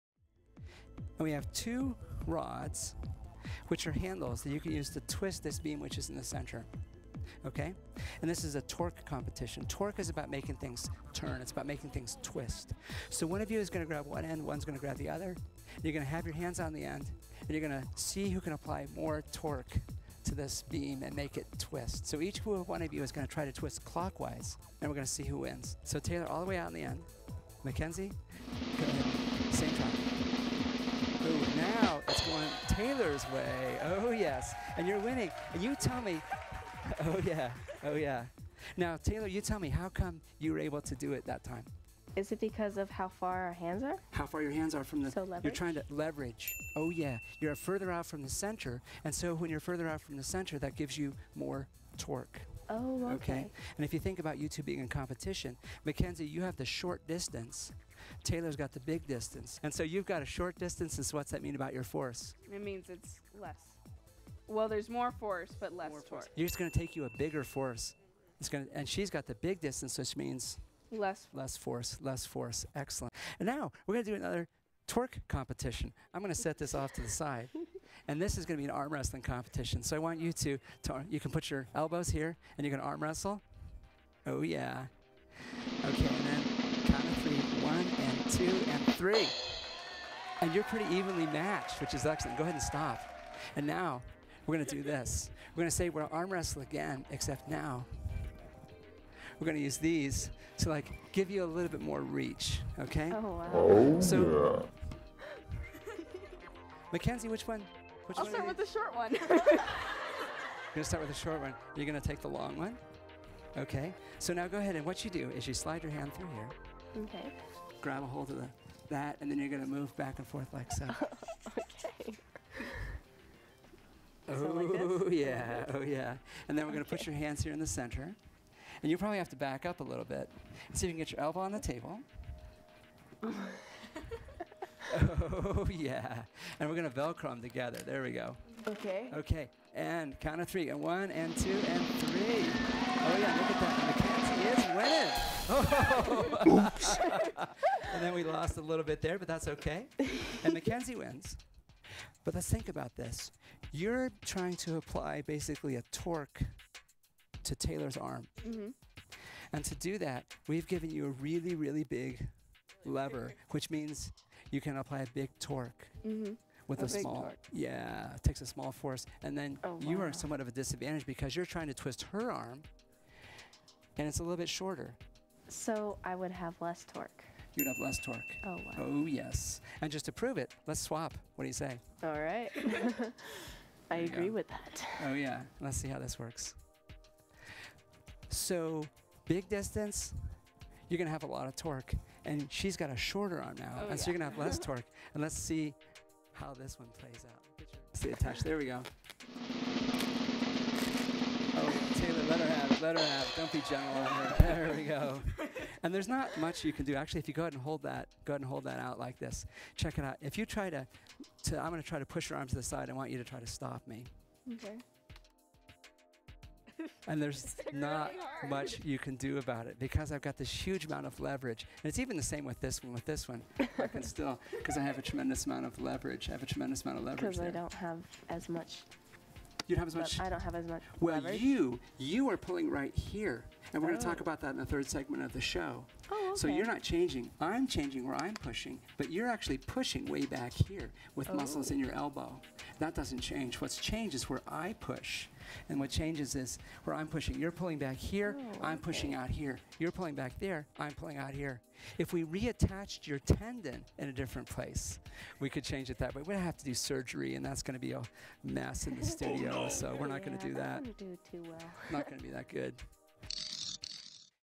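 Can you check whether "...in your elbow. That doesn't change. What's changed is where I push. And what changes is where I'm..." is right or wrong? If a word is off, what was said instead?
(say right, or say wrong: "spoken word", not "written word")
right.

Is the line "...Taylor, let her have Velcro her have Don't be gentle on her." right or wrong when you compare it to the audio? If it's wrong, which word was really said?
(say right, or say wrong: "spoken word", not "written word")
wrong: "Let", not "Velcro".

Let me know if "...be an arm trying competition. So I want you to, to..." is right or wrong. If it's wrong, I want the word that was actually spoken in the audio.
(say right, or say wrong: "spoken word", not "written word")
wrong: "wrestling", not "trying".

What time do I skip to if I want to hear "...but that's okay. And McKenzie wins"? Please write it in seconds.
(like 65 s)
149 s.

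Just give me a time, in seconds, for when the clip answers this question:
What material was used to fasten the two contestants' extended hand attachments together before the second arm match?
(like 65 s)
136 s.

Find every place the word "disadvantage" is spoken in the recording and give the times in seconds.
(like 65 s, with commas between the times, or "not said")
170 s.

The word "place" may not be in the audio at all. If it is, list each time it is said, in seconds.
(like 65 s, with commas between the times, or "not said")
254 s.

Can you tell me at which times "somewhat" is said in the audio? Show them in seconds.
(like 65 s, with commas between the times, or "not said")
170 s.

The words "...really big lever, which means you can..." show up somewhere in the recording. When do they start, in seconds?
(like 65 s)
161 s.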